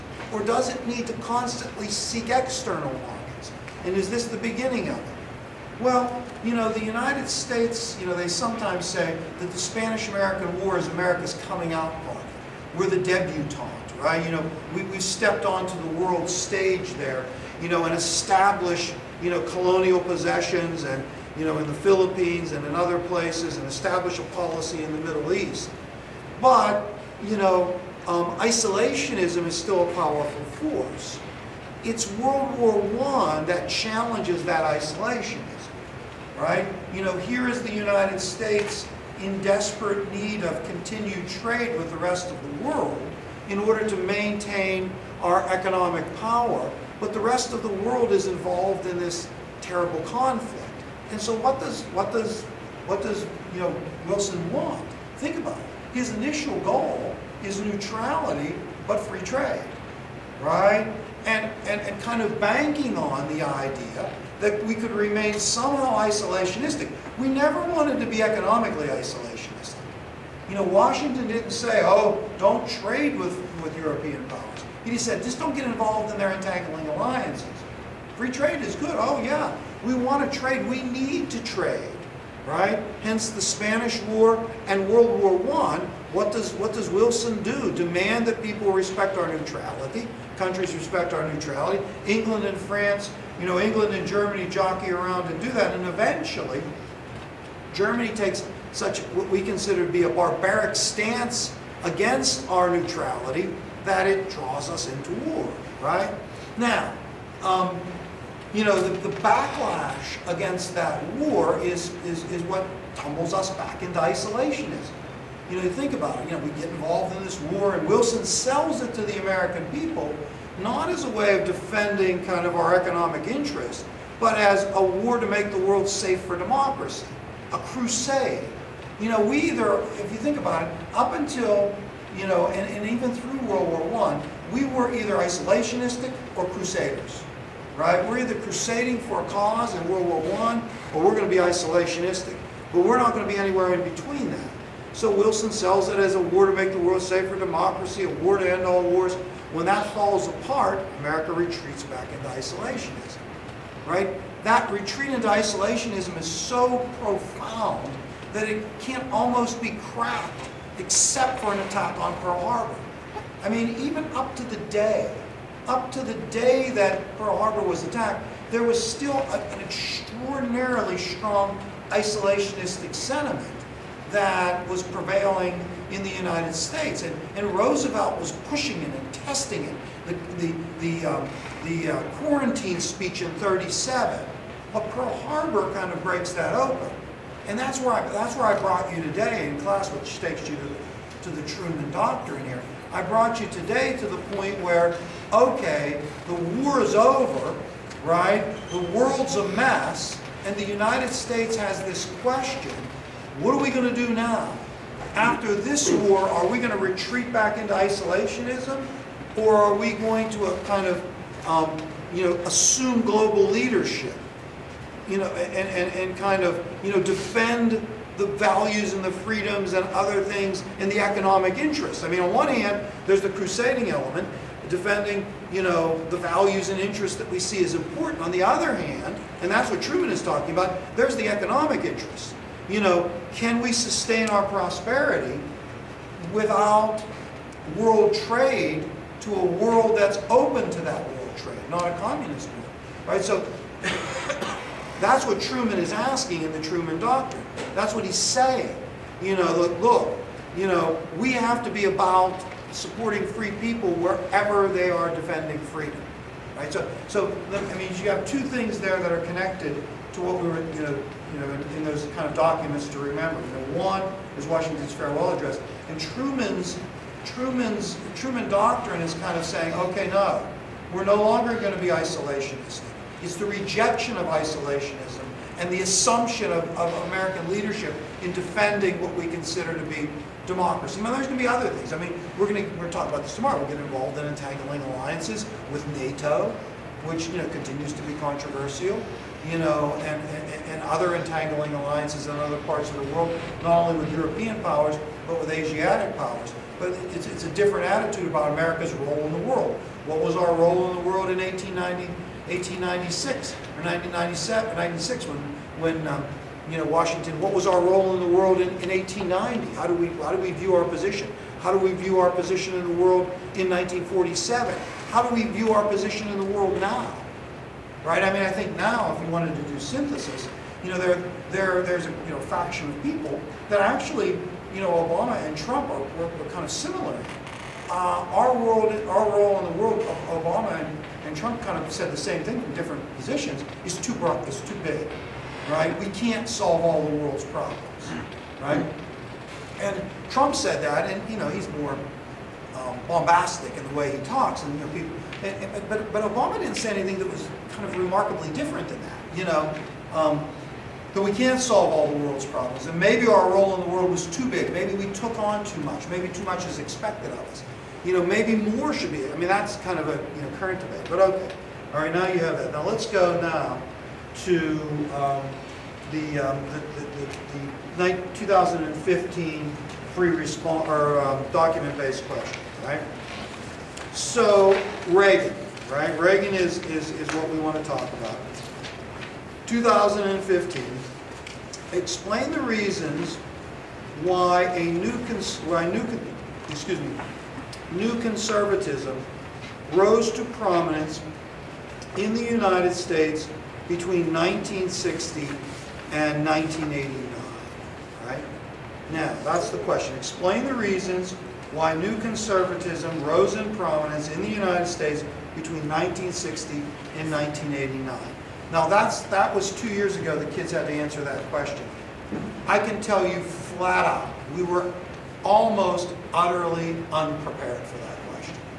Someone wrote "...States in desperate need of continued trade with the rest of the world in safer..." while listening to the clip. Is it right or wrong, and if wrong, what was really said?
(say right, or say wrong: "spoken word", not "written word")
wrong: "order", not "safer".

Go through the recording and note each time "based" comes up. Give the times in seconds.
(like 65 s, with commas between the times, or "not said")
371 s.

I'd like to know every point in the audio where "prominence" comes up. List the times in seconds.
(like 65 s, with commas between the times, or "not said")
390 s, 403 s.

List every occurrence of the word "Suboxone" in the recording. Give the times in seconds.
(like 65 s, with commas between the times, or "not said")
not said.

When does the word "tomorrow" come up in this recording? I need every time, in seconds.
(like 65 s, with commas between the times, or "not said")
283 s.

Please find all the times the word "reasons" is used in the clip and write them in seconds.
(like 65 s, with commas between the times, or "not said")
382 s, 400 s.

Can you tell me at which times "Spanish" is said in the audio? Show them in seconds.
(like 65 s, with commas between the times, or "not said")
9 s, 83 s.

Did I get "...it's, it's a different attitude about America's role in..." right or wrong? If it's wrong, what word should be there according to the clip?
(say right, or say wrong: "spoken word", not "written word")
right.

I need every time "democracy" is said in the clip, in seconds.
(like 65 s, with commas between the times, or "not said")
126 s, 147 s, 280 s.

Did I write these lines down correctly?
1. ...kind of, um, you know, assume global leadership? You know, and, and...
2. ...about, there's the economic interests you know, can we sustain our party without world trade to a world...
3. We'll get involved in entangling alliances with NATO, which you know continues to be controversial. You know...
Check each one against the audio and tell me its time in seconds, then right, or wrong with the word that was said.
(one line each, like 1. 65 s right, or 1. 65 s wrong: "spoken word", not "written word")
1. 210 s right
2. 230 s wrong: "prosperity", not "party"
3. 283 s right.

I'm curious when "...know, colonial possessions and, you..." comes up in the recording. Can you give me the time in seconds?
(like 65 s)
19 s.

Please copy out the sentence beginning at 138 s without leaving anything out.
We're either crusading for a cause in World War I, or we're going to be isolationistic.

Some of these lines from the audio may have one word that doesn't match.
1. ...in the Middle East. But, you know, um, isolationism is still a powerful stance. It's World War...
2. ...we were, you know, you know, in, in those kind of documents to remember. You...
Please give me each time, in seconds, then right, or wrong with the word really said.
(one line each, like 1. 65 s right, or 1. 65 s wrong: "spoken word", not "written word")
1. 24 s wrong: "force", not "stance"
2. 260 s right.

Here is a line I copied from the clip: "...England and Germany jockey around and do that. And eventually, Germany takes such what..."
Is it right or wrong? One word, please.
right.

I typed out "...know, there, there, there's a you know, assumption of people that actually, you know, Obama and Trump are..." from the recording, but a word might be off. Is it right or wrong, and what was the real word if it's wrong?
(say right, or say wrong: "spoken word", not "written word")
wrong: "faction", not "assumption".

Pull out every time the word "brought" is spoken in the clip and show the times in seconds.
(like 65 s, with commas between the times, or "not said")
188 s, 193 s.